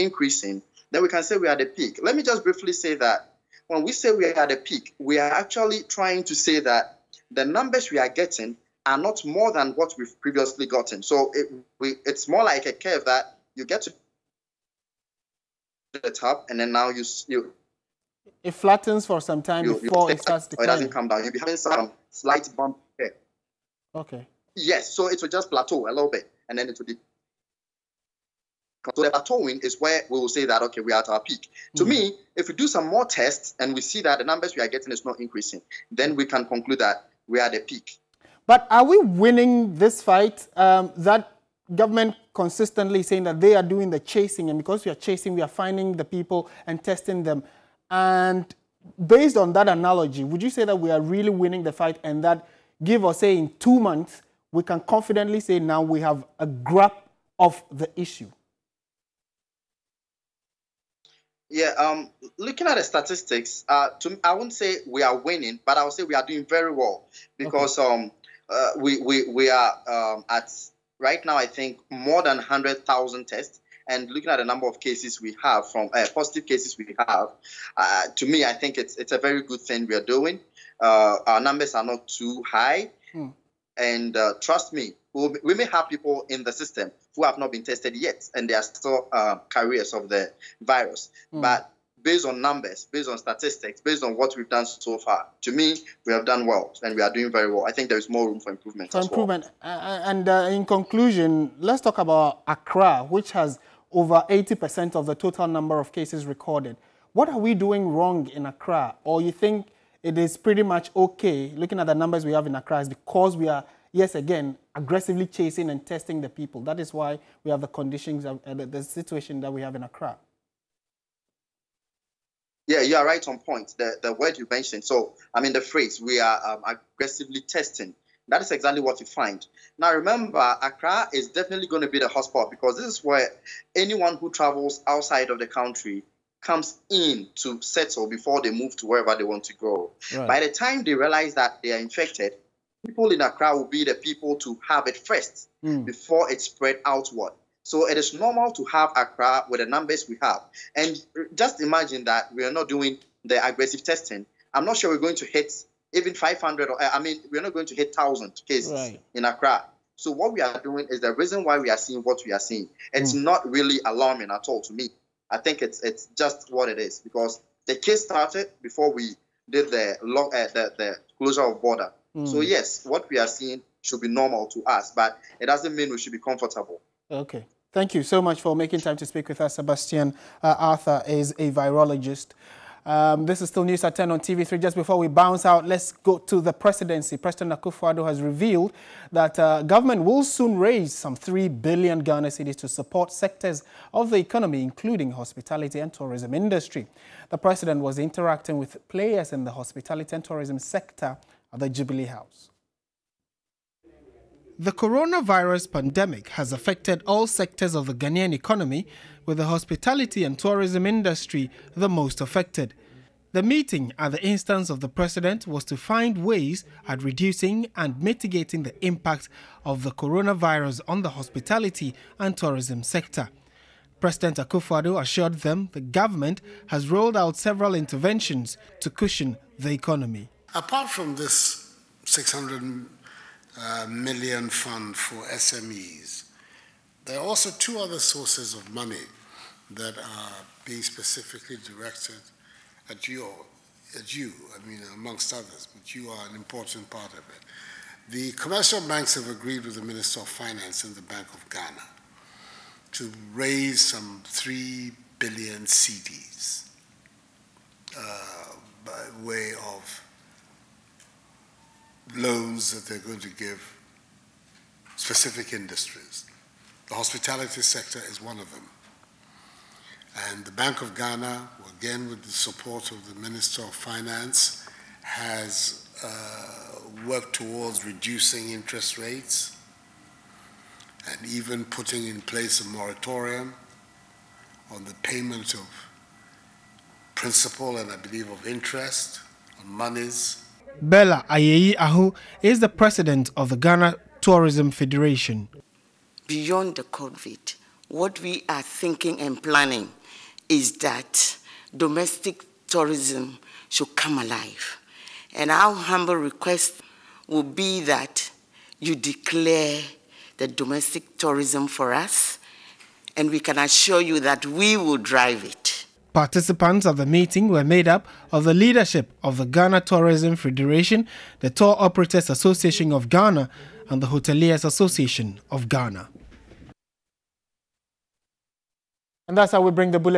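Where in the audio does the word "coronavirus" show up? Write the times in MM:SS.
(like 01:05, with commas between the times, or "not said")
03:24, 03:39.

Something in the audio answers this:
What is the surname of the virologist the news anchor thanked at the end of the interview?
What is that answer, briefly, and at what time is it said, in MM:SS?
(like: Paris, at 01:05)
Arthur, at 03:00.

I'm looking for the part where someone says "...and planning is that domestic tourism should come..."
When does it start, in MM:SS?
04:59.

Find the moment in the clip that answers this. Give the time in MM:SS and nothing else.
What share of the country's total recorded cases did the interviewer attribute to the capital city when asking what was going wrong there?
01:43.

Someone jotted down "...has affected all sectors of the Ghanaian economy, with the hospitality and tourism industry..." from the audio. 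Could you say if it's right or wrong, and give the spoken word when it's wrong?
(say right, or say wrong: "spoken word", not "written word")
right.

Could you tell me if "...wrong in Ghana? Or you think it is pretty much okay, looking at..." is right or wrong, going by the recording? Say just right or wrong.
wrong.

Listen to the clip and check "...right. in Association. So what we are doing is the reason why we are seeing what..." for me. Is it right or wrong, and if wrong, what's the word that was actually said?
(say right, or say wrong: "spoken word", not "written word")
wrong: "Accra", not "Association".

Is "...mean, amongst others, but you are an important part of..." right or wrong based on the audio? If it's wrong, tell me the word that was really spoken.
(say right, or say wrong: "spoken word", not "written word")
right.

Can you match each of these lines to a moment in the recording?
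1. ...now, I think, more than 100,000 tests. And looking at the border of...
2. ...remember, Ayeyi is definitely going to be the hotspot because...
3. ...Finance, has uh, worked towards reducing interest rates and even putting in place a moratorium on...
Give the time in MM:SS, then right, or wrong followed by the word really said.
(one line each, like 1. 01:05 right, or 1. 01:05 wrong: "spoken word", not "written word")
1. 01:11 wrong: "number", not "border"
2. 02:09 wrong: "Accra", not "Ayeyi"
3. 04:33 right.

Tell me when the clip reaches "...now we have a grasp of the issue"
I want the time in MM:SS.
00:55.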